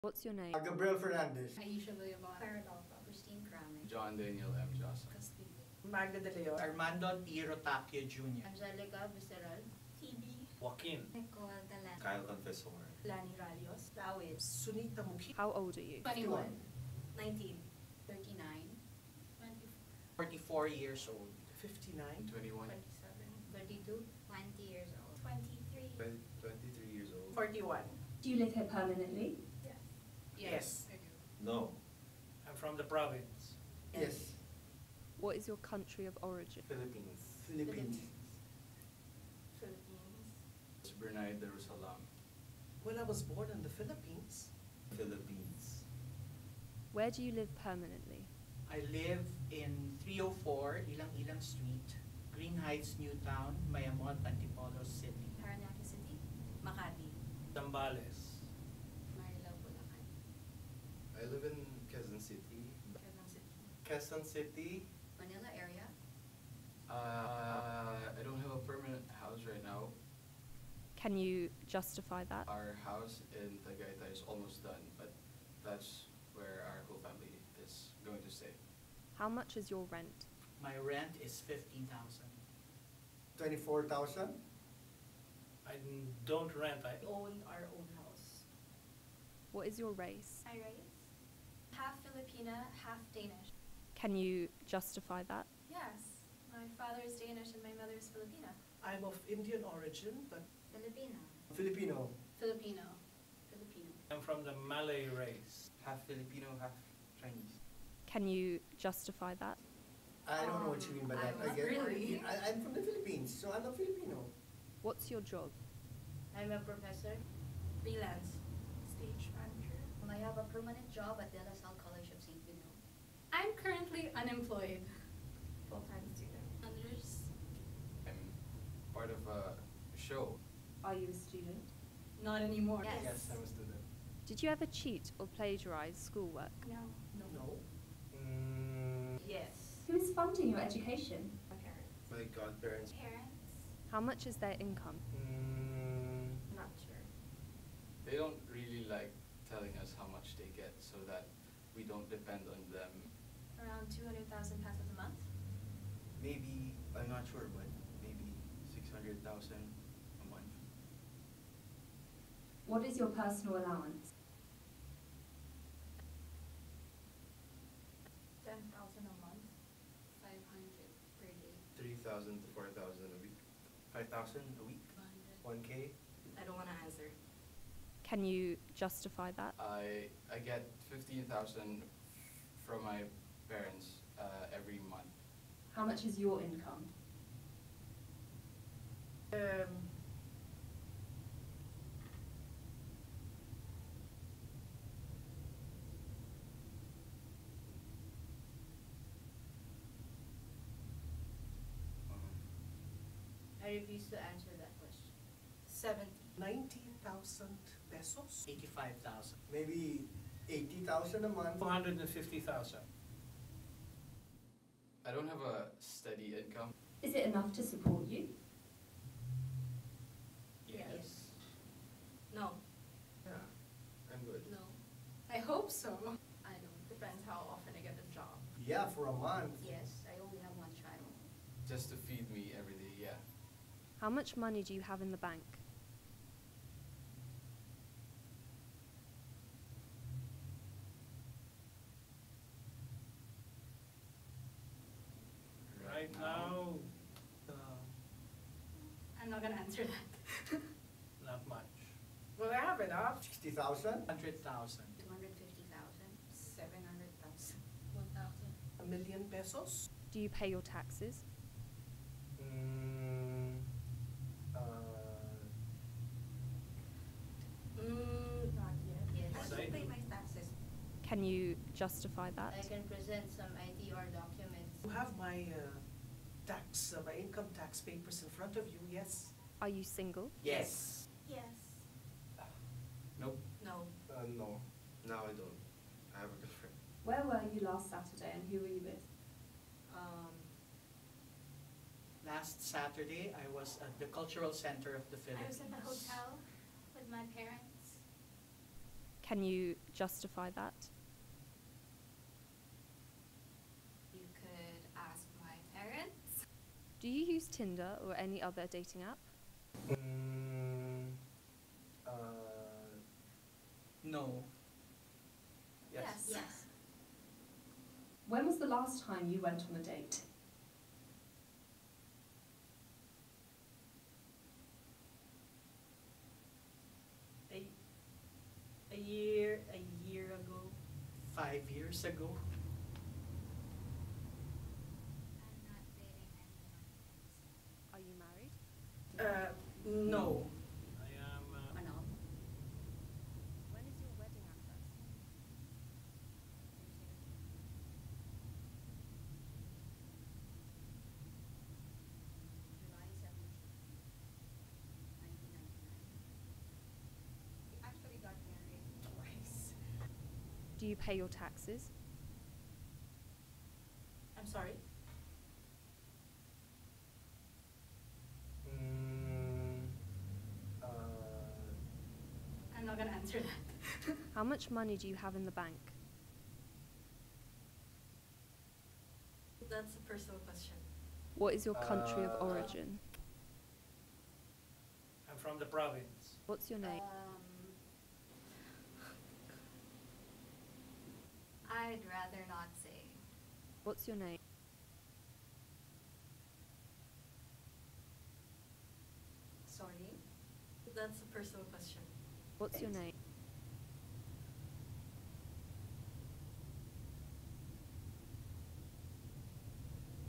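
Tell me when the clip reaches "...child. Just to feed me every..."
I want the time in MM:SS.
03:50.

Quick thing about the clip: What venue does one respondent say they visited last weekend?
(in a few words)
Cultural Center of the Philippines.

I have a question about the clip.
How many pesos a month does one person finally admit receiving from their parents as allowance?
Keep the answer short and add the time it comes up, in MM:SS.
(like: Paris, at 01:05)
15,000, at 03:00.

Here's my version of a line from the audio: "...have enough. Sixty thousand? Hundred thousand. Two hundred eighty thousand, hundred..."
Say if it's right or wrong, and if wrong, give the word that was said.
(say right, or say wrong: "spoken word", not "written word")
wrong: "fifty", not "eighty".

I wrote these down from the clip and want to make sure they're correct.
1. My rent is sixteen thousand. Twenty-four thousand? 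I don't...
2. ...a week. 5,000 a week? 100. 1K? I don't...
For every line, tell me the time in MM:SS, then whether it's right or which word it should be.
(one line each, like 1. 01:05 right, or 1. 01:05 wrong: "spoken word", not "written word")
1. 01:20 wrong: "fifteen", not "sixteen"
2. 02:53 right.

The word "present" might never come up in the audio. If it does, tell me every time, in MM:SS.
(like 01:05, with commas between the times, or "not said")
04:32.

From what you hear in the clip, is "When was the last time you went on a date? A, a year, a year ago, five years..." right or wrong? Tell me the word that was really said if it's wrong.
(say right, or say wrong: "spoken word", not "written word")
right.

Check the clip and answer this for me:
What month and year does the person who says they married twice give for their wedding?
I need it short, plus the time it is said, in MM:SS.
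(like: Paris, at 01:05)
July 1999, at 05:44.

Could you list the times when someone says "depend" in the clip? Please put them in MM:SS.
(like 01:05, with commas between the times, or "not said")
02:32, 03:46.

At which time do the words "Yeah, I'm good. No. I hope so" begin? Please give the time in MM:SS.
03:43.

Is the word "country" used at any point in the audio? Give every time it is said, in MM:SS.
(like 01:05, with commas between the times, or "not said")
00:35, 06:21.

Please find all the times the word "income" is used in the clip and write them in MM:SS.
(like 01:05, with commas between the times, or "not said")
02:24, 03:06, 03:36, 04:37.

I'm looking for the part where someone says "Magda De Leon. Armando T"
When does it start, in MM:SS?
00:05.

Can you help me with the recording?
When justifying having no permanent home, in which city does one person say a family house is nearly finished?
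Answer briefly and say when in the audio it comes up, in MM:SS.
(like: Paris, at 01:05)
Tagaytay, at 01:12.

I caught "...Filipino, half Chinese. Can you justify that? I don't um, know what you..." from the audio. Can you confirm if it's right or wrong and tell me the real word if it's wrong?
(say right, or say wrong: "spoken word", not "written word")
right.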